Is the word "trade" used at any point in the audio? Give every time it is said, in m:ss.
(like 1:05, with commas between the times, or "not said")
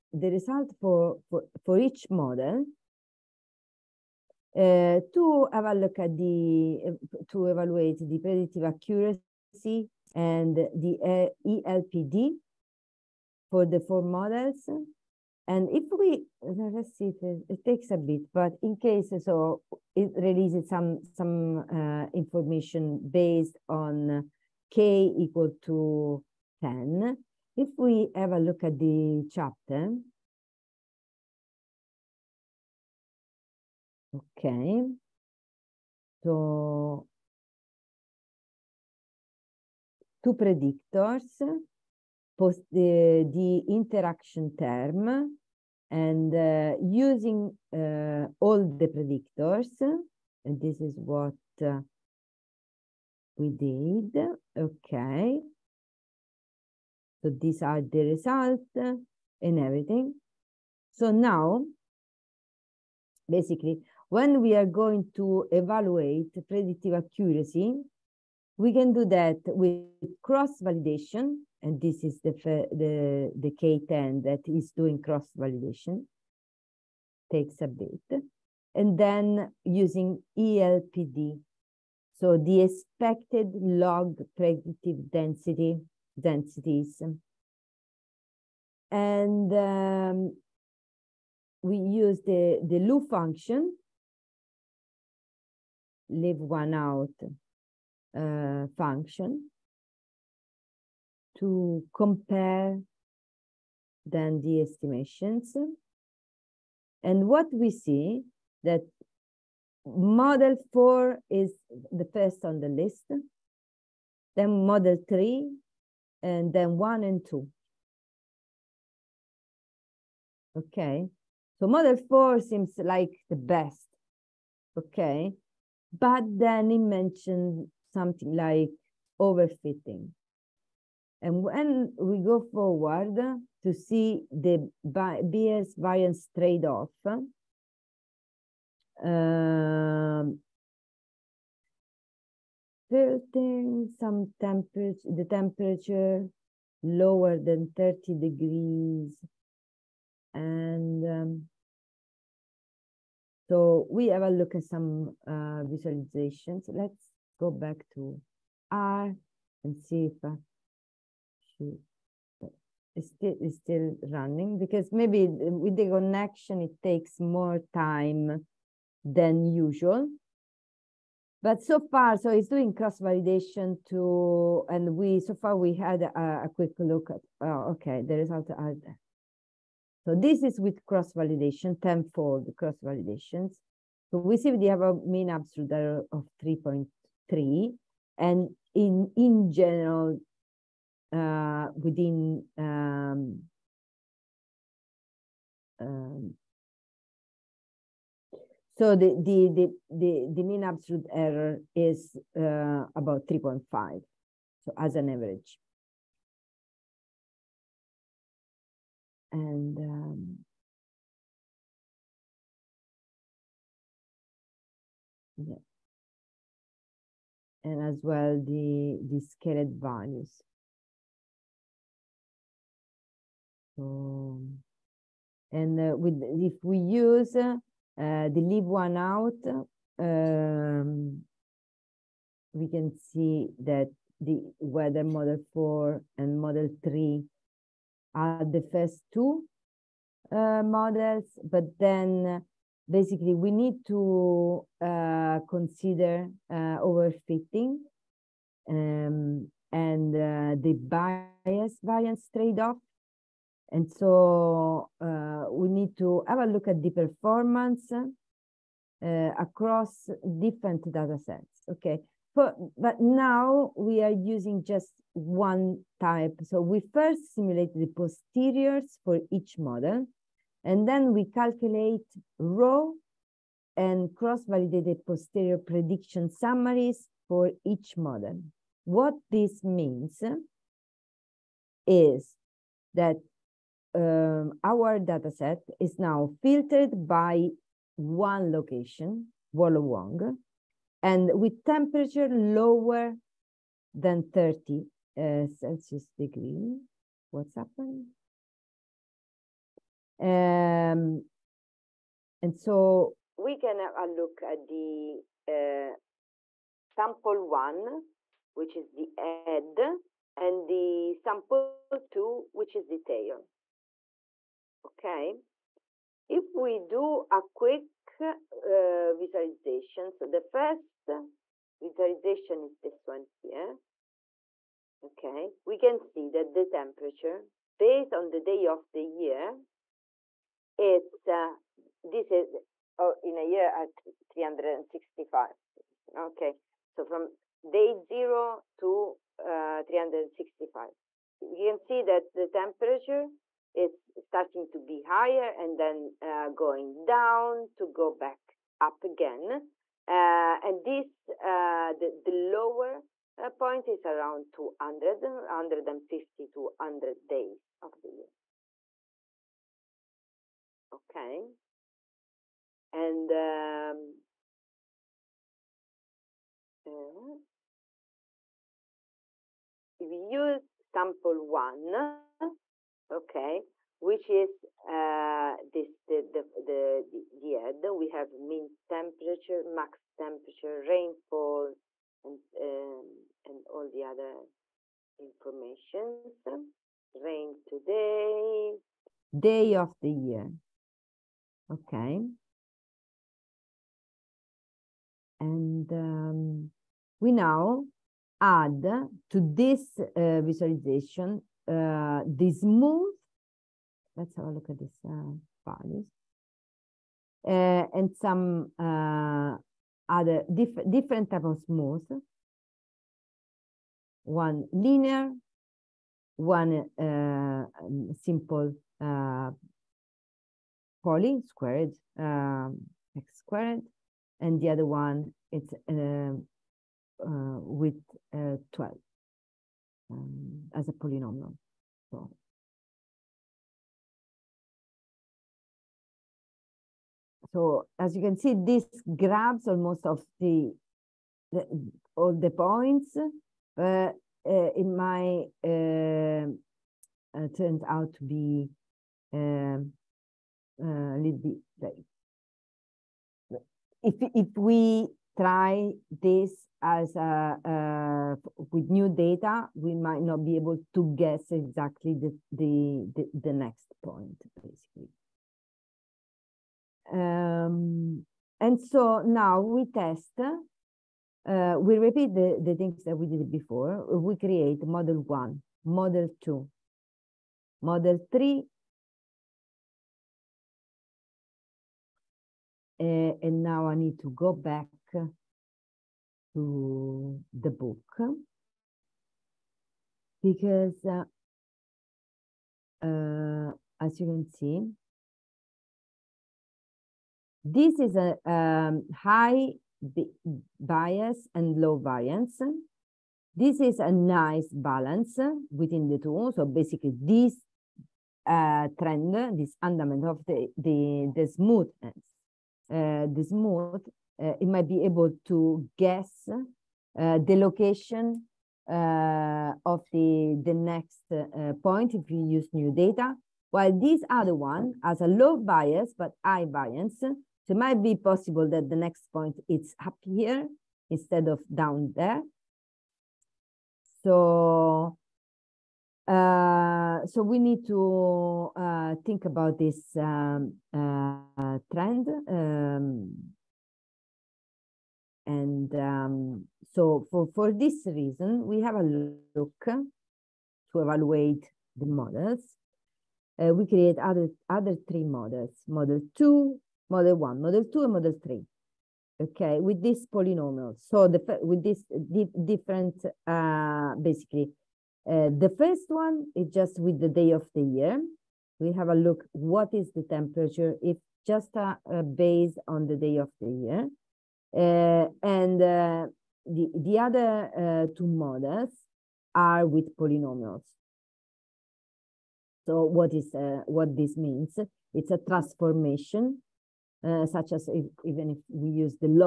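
2:16, 4:12.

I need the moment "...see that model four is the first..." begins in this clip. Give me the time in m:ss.
1:47.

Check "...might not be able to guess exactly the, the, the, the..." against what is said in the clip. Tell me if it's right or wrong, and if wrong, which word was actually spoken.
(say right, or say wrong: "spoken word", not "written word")
right.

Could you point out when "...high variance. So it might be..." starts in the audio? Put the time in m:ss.
8:46.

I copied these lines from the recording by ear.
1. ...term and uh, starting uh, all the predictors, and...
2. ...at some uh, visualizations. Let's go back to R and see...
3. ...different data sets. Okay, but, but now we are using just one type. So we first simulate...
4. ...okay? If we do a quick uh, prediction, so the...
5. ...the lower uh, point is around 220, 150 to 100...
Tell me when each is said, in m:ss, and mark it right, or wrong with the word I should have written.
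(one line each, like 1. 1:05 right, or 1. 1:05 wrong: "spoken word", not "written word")
1. 0:44 wrong: "using", not "starting"
2. 2:34 right
3. 4:20 right
4. 5:14 wrong: "visualization", not "prediction"
5. 5:52 wrong: "200", not "220".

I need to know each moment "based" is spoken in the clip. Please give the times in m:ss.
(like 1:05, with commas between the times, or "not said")
0:23, 5:27, 9:32.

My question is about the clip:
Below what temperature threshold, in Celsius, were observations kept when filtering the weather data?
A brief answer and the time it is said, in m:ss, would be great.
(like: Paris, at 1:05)
30, at 4:54.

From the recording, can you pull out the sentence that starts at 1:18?
And then using ELPD, so the expected log predictive density, densities.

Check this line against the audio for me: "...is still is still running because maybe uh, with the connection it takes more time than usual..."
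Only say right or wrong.
right.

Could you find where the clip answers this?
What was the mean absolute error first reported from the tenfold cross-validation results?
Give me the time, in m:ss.
3:06.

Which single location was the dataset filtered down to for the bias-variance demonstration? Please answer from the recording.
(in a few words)
Wollongong.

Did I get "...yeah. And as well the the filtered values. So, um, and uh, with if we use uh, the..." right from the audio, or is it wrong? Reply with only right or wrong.
wrong.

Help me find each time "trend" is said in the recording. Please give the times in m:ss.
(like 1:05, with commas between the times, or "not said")
8:28, 9:01.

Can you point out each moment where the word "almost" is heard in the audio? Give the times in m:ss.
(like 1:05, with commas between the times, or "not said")
7:19.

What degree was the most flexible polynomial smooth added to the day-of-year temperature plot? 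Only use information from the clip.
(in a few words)
12.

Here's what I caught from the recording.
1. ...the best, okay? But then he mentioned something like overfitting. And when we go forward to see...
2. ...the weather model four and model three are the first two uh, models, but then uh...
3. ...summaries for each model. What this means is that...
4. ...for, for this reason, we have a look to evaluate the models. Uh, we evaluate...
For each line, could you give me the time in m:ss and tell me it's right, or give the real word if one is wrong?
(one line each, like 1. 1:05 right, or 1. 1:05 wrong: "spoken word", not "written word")
1. 2:03 right
2. 3:54 right
3. 4:36 right
4. 9:07 wrong: "create", not "evaluate".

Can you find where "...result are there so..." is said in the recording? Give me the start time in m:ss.
2:58.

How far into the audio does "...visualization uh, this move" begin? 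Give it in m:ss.
6:40.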